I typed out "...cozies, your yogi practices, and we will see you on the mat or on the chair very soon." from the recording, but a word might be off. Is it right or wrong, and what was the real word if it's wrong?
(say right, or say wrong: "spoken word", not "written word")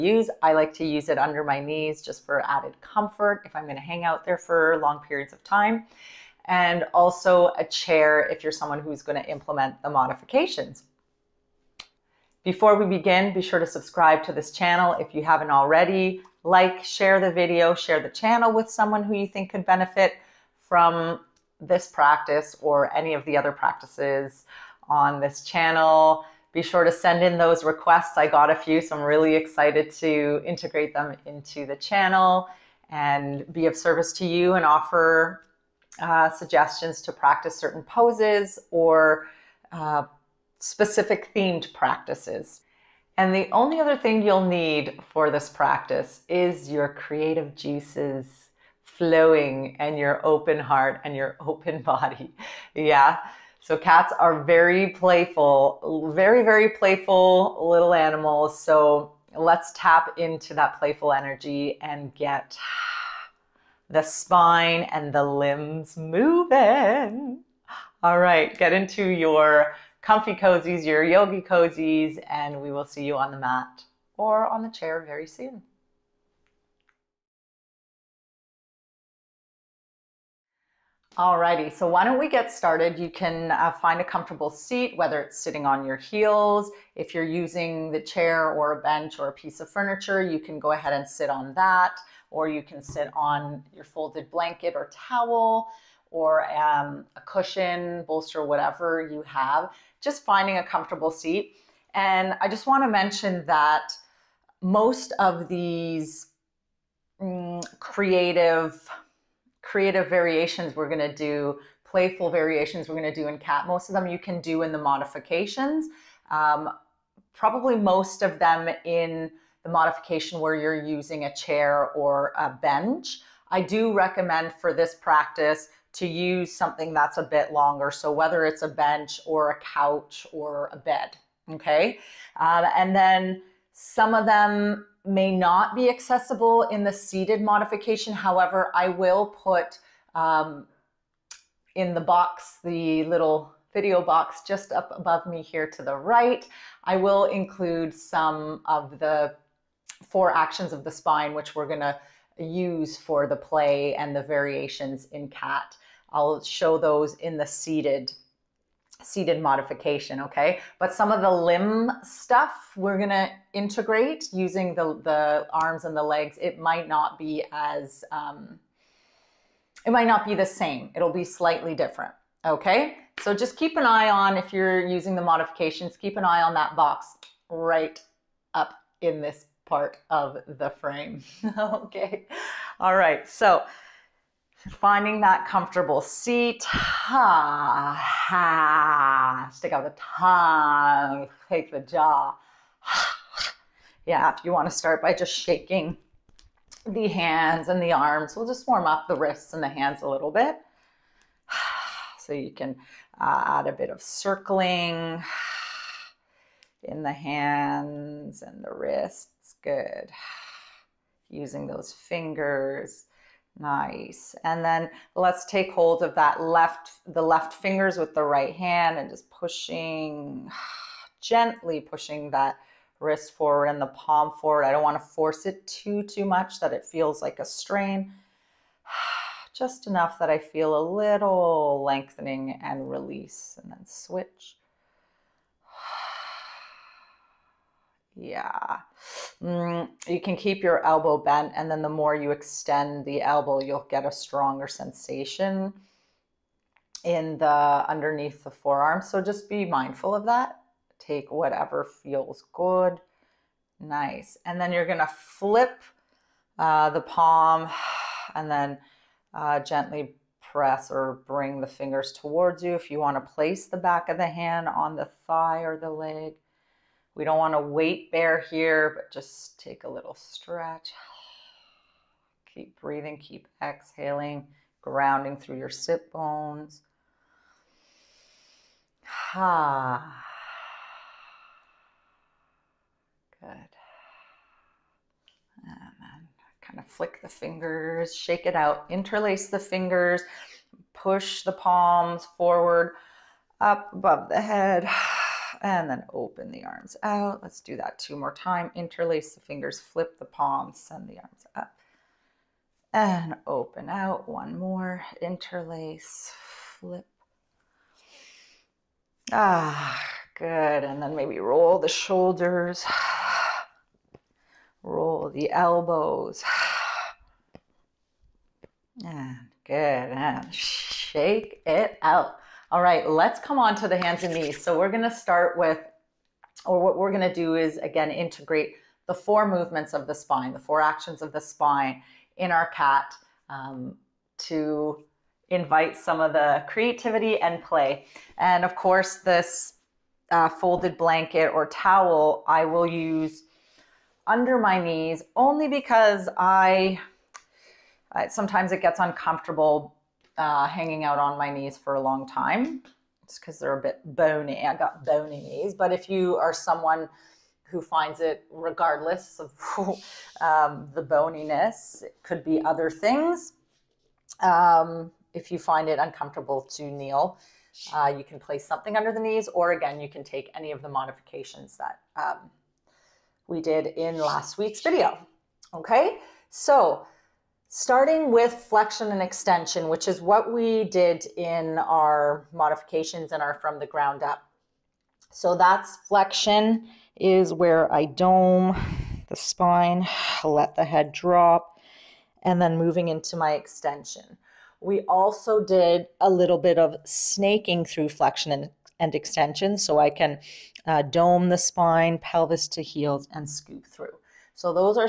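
wrong: "cozies", not "practices".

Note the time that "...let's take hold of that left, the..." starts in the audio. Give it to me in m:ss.
3:35.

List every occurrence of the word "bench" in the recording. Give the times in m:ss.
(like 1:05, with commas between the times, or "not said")
1:28, 2:02, 2:08.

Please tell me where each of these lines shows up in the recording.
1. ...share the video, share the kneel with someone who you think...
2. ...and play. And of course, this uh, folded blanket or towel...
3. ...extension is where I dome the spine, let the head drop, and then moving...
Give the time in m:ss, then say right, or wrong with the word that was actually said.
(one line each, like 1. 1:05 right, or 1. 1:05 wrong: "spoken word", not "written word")
1. 0:16 wrong: "channel", not "kneel"
2. 5:37 right
3. 6:26 wrong: "flexion", not "extension".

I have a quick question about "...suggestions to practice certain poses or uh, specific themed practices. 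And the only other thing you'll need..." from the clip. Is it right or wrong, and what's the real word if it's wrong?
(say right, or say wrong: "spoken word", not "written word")
right.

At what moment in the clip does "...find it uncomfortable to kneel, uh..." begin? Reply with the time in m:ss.
6:05.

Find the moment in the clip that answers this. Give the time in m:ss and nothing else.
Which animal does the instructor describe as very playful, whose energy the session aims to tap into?
0:53.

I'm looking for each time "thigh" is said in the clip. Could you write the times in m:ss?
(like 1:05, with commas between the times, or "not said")
4:25.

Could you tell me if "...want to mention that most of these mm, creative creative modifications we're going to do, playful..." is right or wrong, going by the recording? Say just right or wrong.
wrong.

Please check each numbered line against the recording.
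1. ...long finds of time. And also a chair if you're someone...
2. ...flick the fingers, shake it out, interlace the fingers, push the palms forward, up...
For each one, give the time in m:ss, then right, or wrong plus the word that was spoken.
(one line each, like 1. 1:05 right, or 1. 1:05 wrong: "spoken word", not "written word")
1. 0:04 wrong: "periods", not "finds"
2. 4:46 right.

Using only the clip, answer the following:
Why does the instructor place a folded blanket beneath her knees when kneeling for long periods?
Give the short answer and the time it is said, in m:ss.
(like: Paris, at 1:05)
Bony knees, at 5:55.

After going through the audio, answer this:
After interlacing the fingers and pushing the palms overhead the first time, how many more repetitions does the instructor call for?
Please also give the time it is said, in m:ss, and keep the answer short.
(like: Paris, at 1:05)
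2, at 4:57.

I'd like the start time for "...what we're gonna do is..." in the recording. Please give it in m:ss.
5:26.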